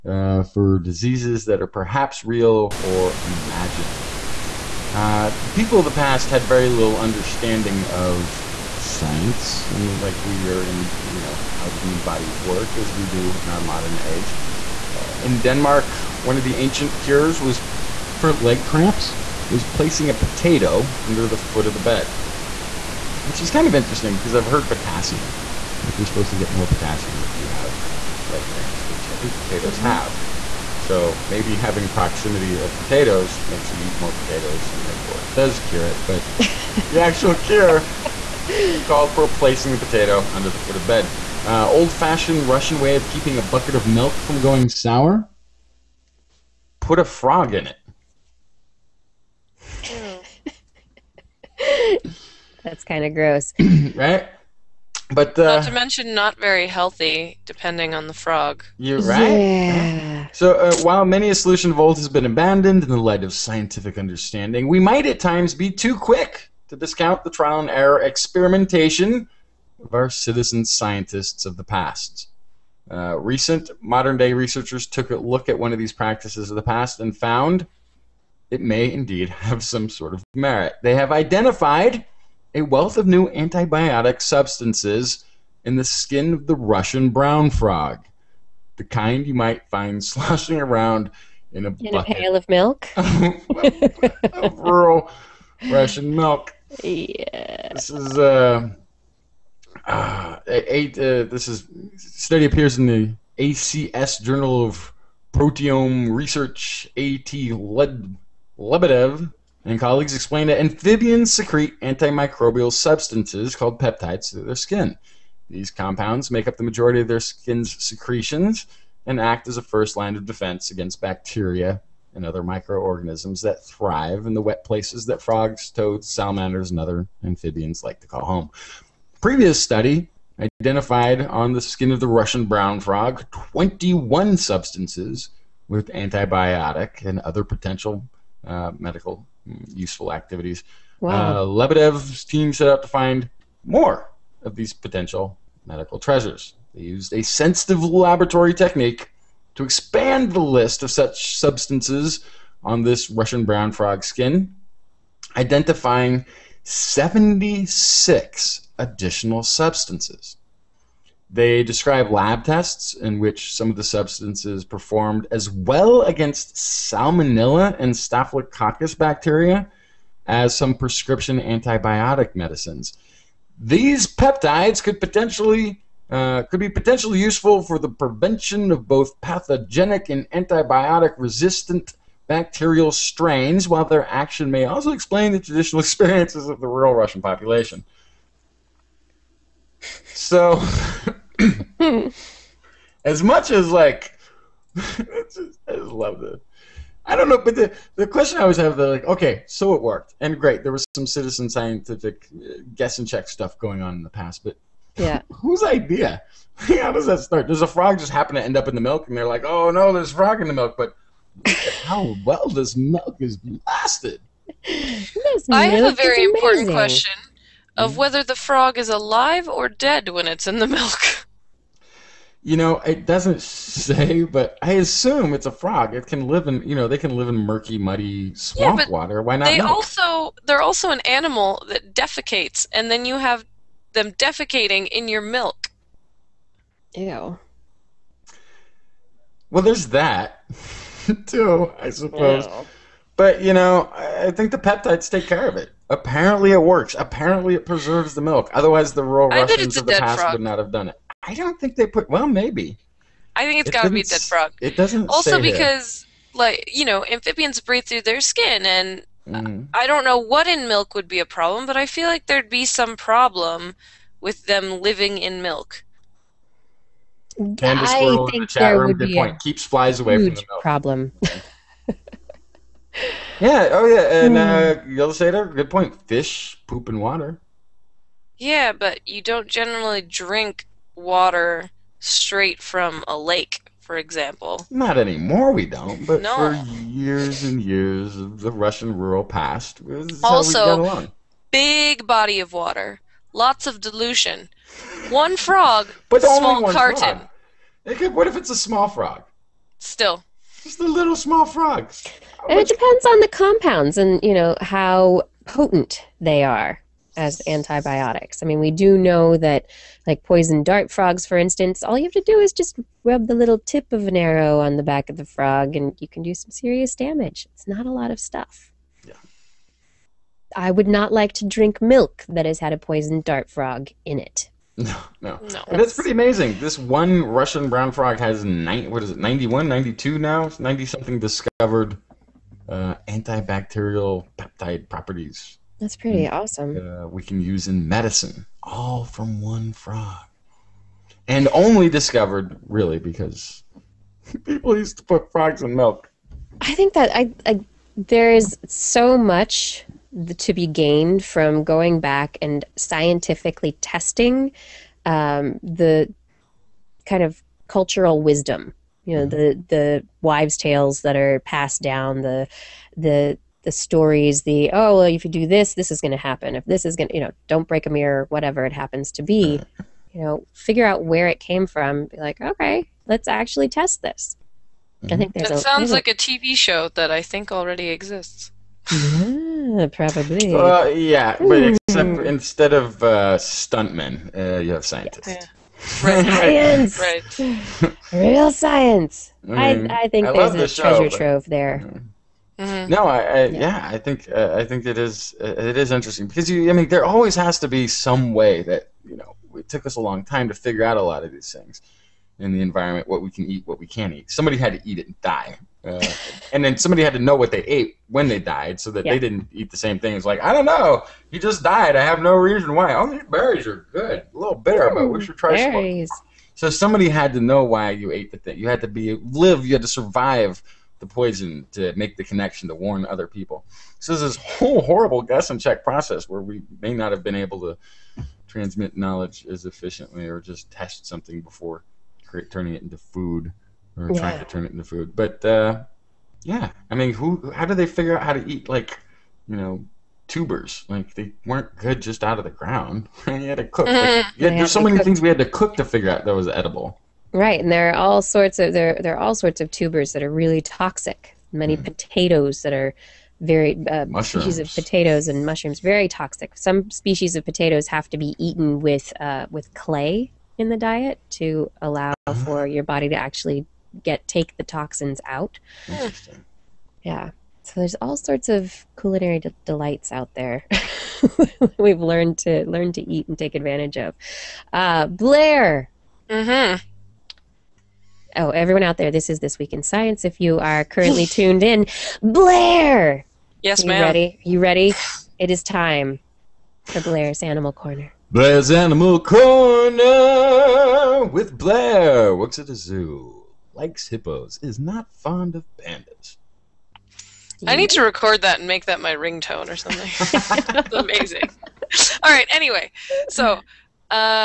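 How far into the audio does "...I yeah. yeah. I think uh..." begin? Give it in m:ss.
6:33.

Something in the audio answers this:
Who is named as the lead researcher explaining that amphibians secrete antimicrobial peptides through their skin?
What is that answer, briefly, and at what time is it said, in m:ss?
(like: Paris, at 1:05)
A.T. Lebedev, at 1:46.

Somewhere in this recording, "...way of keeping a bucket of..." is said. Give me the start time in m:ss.
0:42.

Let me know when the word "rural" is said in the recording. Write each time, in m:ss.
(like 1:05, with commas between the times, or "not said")
1:34, 3:06, 4:48.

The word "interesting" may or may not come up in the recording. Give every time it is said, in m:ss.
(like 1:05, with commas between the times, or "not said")
0:23, 6:35, 7:45.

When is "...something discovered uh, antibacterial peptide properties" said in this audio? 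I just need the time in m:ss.
5:30.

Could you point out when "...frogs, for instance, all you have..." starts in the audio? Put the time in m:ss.
5:10.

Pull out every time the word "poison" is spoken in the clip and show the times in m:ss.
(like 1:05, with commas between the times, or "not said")
5:10, 5:22, 7:01.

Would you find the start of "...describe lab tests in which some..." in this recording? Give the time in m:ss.
2:41.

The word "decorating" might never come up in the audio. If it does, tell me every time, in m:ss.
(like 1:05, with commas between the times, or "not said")
not said.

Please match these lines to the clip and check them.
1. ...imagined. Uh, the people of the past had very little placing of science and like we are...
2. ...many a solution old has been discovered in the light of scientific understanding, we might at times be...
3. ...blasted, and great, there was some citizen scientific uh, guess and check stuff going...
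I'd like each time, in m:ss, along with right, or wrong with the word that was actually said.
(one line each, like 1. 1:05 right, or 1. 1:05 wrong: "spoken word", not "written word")
1. 0:03 wrong: "understanding", not "placing"
2. 1:01 wrong: "abandoned", not "discovered"
3. 3:19 wrong: "worked", not "blasted".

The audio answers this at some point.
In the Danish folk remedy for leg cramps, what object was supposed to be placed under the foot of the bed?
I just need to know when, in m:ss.
0:20.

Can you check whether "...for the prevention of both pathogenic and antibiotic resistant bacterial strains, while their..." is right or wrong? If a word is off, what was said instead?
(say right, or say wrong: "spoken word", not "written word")
right.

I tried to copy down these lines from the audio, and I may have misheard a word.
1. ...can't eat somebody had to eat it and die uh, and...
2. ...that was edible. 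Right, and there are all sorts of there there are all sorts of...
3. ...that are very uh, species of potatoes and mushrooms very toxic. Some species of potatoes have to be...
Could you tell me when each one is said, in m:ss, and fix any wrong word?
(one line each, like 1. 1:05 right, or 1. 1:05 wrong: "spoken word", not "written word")
1. 6:43 right
2. 7:26 right
3. 7:32 right.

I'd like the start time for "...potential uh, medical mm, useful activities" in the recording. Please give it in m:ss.
2:17.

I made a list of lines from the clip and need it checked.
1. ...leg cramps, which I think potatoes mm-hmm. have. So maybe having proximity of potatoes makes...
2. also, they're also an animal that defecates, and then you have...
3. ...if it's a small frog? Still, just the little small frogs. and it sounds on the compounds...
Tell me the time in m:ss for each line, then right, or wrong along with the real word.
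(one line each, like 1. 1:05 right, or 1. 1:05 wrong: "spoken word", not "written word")
1. 0:28 right
2. 3:49 right
3. 4:58 wrong: "depends", not "sounds".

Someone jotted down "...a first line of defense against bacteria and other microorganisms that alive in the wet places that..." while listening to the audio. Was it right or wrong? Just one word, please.
wrong.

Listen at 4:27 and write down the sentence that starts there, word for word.
Candace I think the there would be a point.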